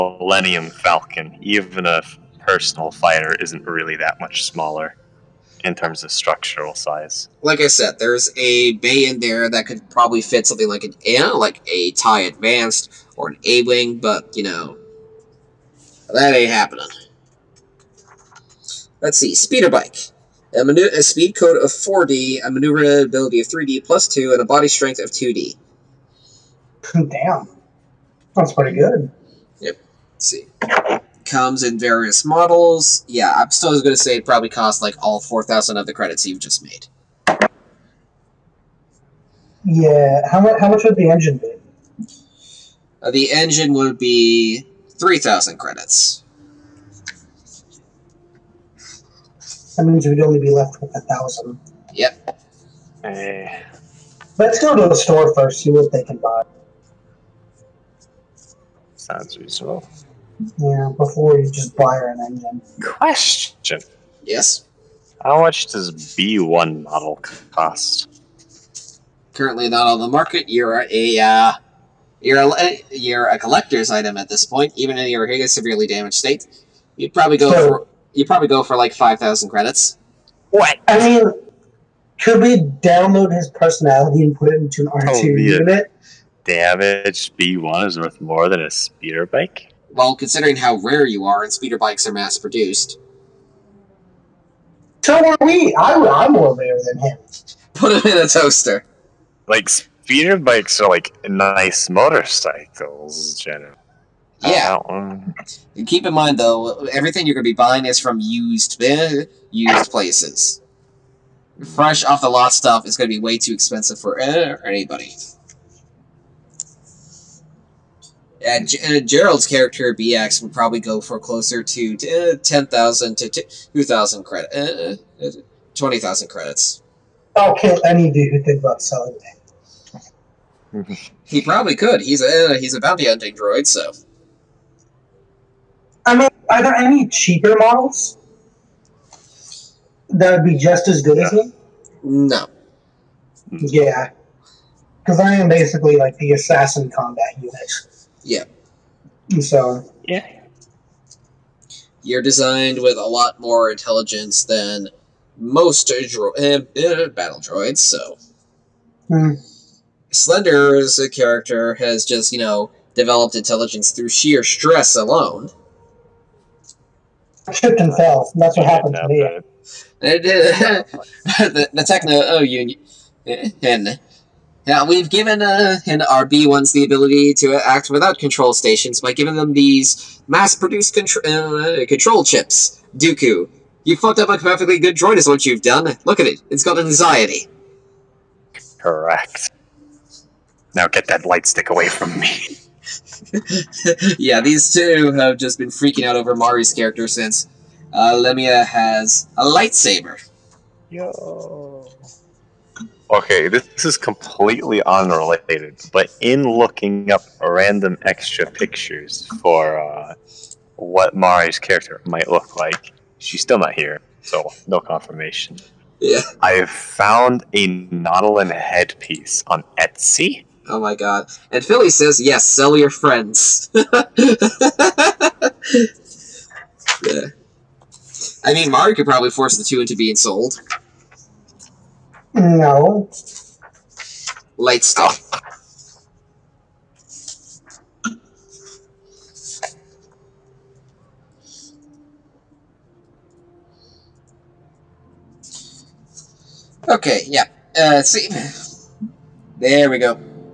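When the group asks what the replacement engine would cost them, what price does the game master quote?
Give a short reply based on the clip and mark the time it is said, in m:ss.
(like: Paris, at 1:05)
3,000 credits, at 0:44.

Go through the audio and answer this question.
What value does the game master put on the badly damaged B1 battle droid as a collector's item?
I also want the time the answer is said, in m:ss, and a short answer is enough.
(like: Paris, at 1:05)
5,000 credits, at 1:18.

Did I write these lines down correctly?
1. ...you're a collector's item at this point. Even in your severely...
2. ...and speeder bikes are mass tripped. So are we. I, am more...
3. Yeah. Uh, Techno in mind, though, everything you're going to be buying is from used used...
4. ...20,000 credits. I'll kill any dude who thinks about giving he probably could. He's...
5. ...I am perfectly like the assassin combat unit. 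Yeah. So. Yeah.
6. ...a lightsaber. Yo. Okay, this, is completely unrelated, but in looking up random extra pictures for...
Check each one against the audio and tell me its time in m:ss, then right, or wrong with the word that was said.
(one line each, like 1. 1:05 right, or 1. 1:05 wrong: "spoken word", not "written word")
1. 1:12 right
2. 1:31 wrong: "produced", not "tripped"
3. 1:44 wrong: "Keep", not "Techno"
4. 2:05 wrong: "selling", not "giving"
5. 2:25 wrong: "basically", not "perfectly"
6. 3:19 right.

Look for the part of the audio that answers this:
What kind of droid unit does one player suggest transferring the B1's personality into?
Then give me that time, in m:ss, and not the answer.
1:24.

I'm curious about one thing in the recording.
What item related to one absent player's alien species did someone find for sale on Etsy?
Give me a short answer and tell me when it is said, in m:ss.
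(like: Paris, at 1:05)
Nautolan headpiece, at 3:37.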